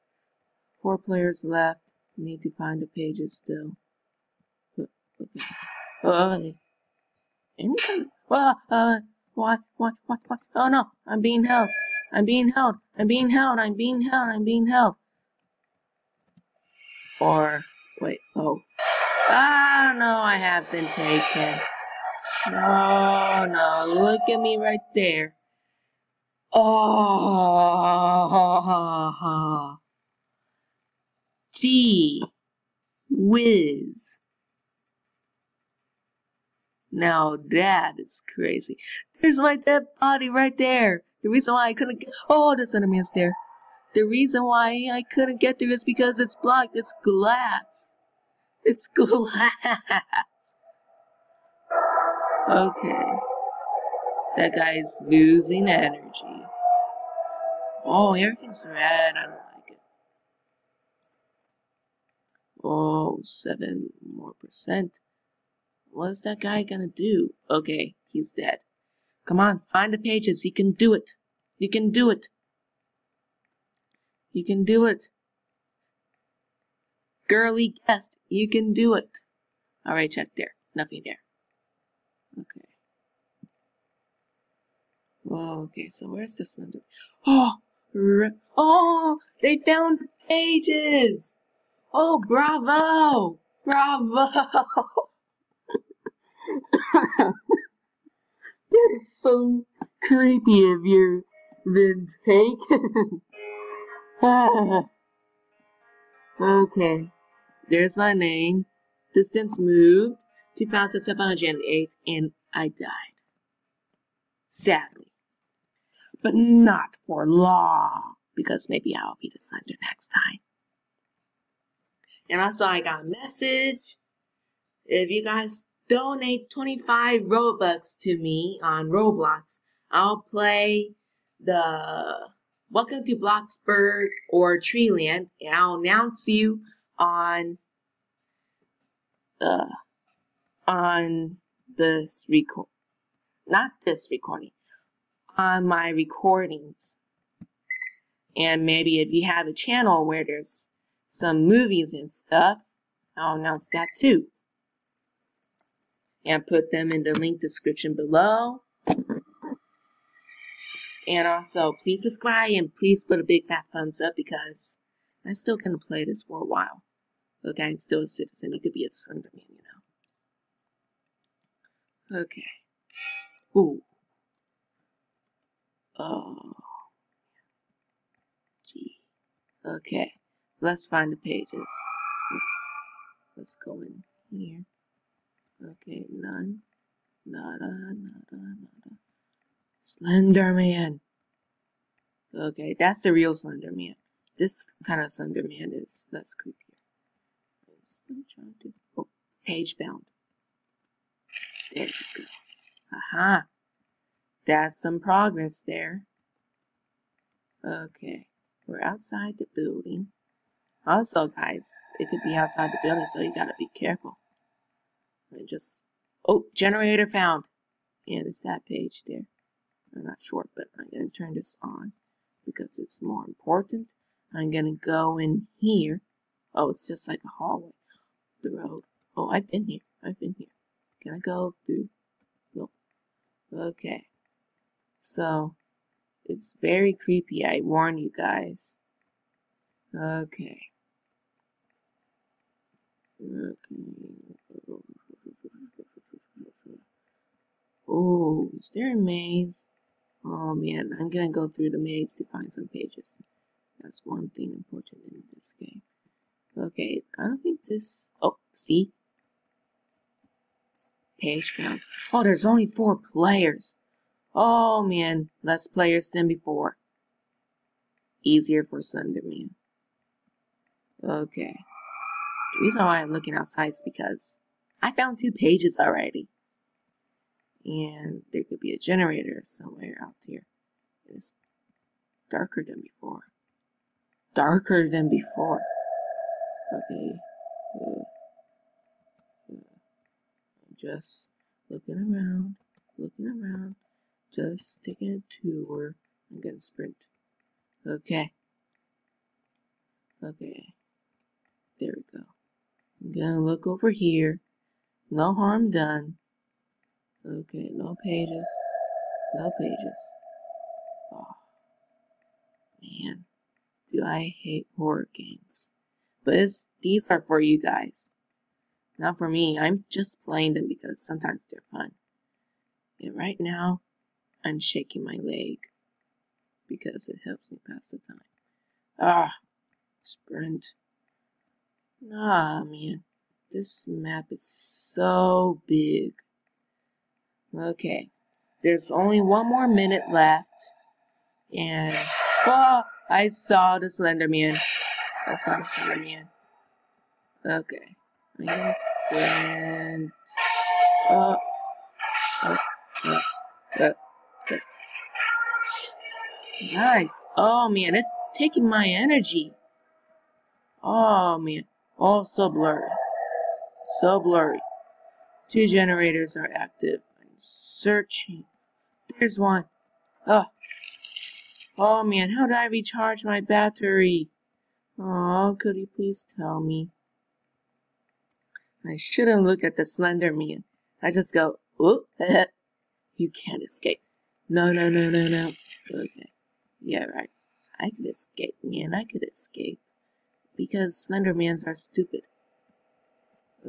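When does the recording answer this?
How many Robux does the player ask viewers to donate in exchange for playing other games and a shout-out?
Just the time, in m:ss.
2:06.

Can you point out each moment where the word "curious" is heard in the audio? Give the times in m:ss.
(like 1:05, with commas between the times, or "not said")
not said.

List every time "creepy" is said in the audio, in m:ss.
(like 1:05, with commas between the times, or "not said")
1:40, 3:16, 3:56.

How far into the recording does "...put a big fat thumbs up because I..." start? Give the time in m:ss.
2:43.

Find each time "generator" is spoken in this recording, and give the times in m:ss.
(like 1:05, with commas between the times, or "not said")
3:36, 4:38, 6:05.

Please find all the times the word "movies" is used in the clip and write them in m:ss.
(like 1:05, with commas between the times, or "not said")
2:31.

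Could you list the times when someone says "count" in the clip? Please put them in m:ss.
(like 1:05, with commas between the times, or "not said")
4:21.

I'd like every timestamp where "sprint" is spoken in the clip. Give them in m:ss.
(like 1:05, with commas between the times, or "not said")
4:56, 5:30.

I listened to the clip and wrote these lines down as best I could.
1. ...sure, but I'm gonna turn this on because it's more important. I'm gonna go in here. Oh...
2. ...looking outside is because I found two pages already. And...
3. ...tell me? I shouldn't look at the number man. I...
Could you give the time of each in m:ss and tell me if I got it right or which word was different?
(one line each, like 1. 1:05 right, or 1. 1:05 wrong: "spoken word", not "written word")
1. 3:40 right
2. 4:33 right
3. 6:16 wrong: "slender", not "number".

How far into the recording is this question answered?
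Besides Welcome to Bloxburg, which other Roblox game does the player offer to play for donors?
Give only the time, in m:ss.
2:14.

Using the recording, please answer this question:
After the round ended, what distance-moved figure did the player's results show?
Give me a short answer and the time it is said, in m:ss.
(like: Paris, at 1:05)
2,708, at 1:50.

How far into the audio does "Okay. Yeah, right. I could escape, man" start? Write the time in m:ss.
6:25.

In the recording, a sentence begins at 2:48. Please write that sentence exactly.
You could be a Slenderman, you know.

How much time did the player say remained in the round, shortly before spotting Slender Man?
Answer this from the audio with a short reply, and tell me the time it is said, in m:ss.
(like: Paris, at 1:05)
1 minute, at 5:39.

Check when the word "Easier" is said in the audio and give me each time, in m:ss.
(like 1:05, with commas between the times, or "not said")
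4:28.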